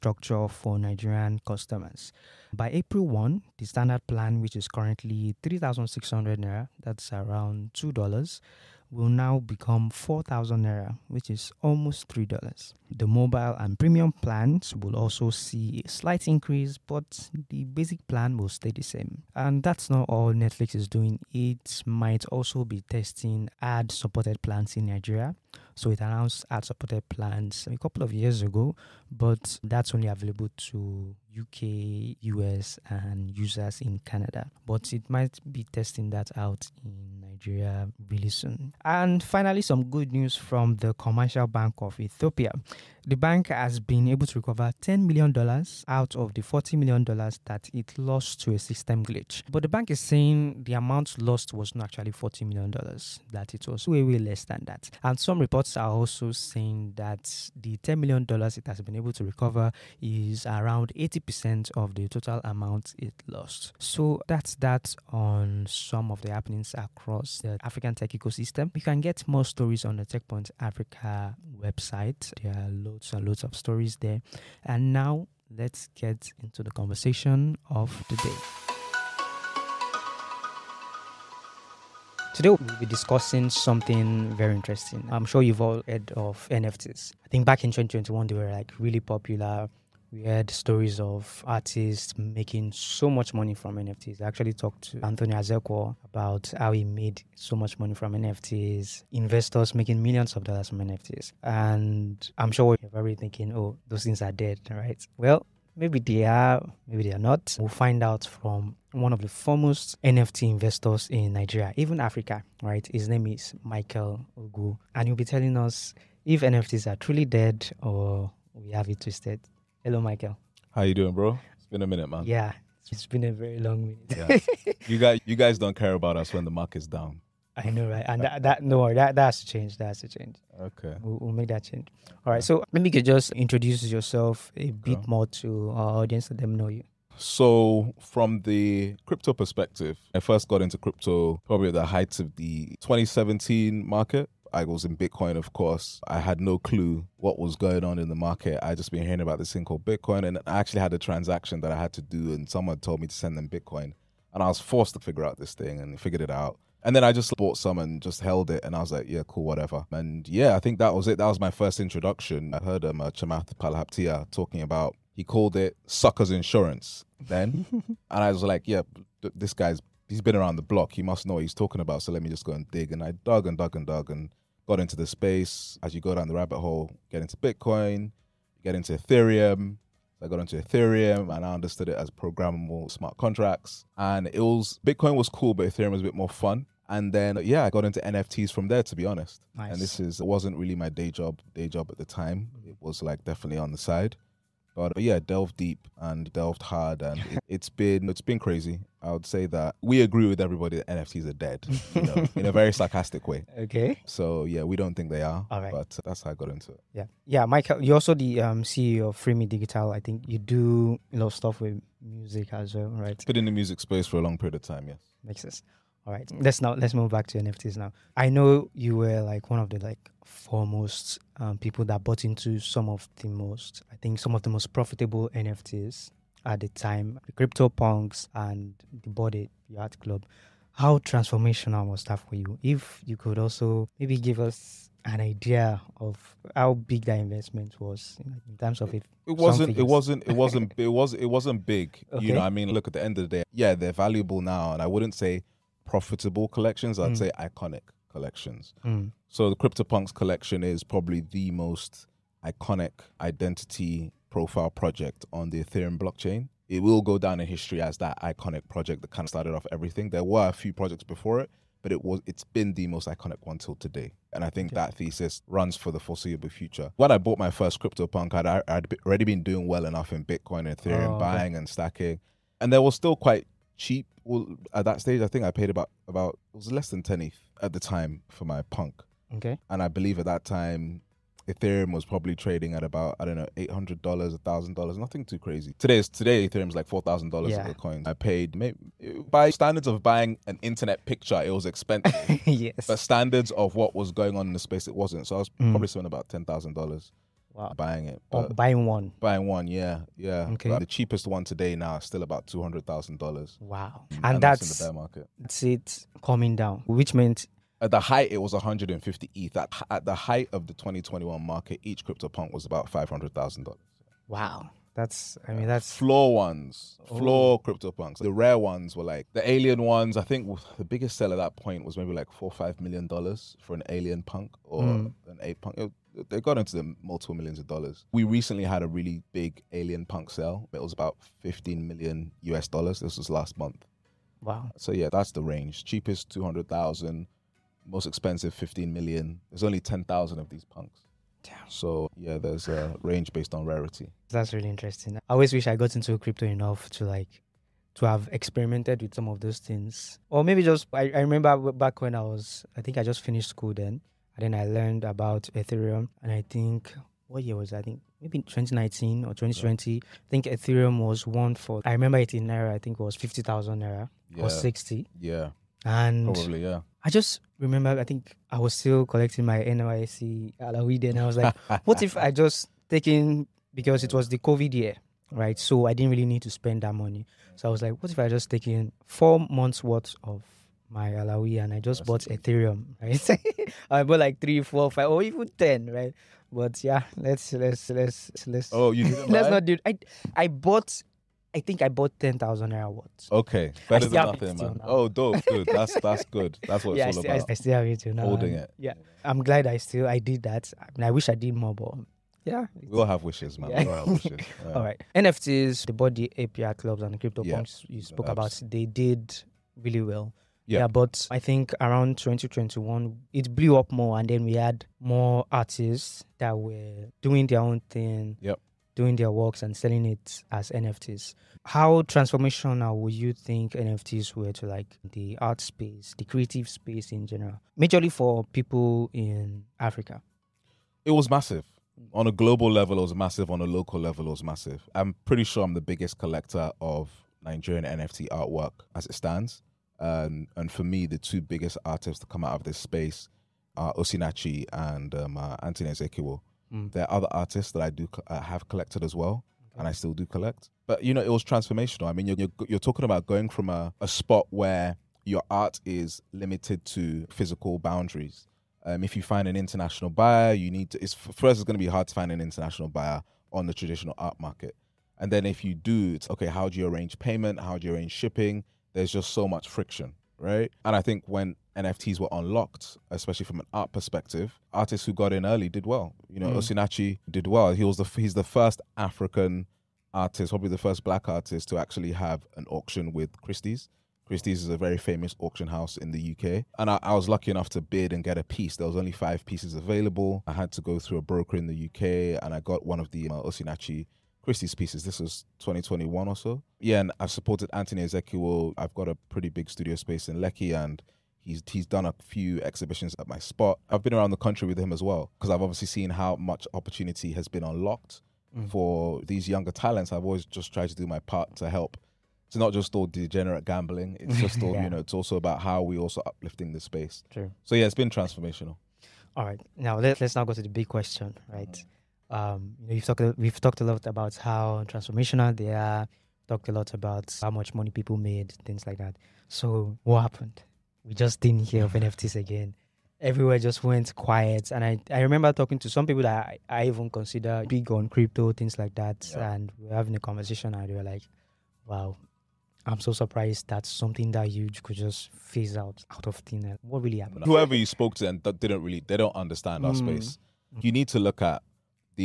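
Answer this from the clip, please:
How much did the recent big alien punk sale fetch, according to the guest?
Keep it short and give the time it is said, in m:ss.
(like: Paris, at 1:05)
$15 million, at 5:31.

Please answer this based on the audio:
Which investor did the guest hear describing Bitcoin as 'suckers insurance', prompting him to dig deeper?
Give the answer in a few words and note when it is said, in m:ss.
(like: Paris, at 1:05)
Chamath Palihapitiya, at 2:43.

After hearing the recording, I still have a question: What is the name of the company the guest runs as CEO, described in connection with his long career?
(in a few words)
Freeme Digital.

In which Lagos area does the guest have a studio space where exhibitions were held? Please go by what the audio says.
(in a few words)
Lekki.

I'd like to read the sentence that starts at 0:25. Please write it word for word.
So it announced ad supported plans a couple of years ago, but that's only available to UK, US, and users in Canada.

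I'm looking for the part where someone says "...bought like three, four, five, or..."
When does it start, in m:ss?
6:24.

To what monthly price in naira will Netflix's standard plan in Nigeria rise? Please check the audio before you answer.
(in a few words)
4,000 naira.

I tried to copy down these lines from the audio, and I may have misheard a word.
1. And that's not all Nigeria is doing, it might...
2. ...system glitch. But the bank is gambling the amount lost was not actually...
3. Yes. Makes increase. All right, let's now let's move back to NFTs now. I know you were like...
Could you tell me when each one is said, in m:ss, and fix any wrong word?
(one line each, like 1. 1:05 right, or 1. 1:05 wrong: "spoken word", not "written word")
1. 0:19 wrong: "Netflix", not "Nigeria"
2. 0:48 wrong: "saying", not "gambling"
3. 3:34 wrong: "sense", not "increase".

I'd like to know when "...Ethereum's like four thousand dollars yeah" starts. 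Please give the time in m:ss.
4:46.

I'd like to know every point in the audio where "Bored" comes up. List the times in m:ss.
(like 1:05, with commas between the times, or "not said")
3:49, 6:45.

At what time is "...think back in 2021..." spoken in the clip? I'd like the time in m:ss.
1:27.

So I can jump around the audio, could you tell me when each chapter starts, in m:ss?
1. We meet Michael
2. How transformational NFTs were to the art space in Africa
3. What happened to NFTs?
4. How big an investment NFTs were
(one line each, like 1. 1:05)
1. 1:59
2. 6:44
3. 8:39
4. 3:37.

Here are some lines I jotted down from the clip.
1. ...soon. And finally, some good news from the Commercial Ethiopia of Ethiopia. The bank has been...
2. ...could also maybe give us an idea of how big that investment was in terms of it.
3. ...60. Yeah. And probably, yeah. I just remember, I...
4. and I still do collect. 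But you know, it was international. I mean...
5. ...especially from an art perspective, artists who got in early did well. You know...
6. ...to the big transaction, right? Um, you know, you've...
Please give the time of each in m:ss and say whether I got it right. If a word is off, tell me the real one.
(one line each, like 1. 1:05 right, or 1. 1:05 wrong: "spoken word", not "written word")
1. 0:38 wrong: "Bank", not "Ethiopia"
2. 3:53 right
3. 6:04 right
4. 7:29 wrong: "transformational", not "international"
5. 7:53 right
6. 8:40 wrong: "question", not "transaction".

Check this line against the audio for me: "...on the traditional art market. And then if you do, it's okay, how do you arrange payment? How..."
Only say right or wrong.
right.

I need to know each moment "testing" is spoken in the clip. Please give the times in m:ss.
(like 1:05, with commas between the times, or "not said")
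0:22, 0:35.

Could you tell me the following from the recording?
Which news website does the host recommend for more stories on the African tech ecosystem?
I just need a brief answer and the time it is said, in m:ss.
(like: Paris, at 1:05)
TechPoint Africa, at 1:10.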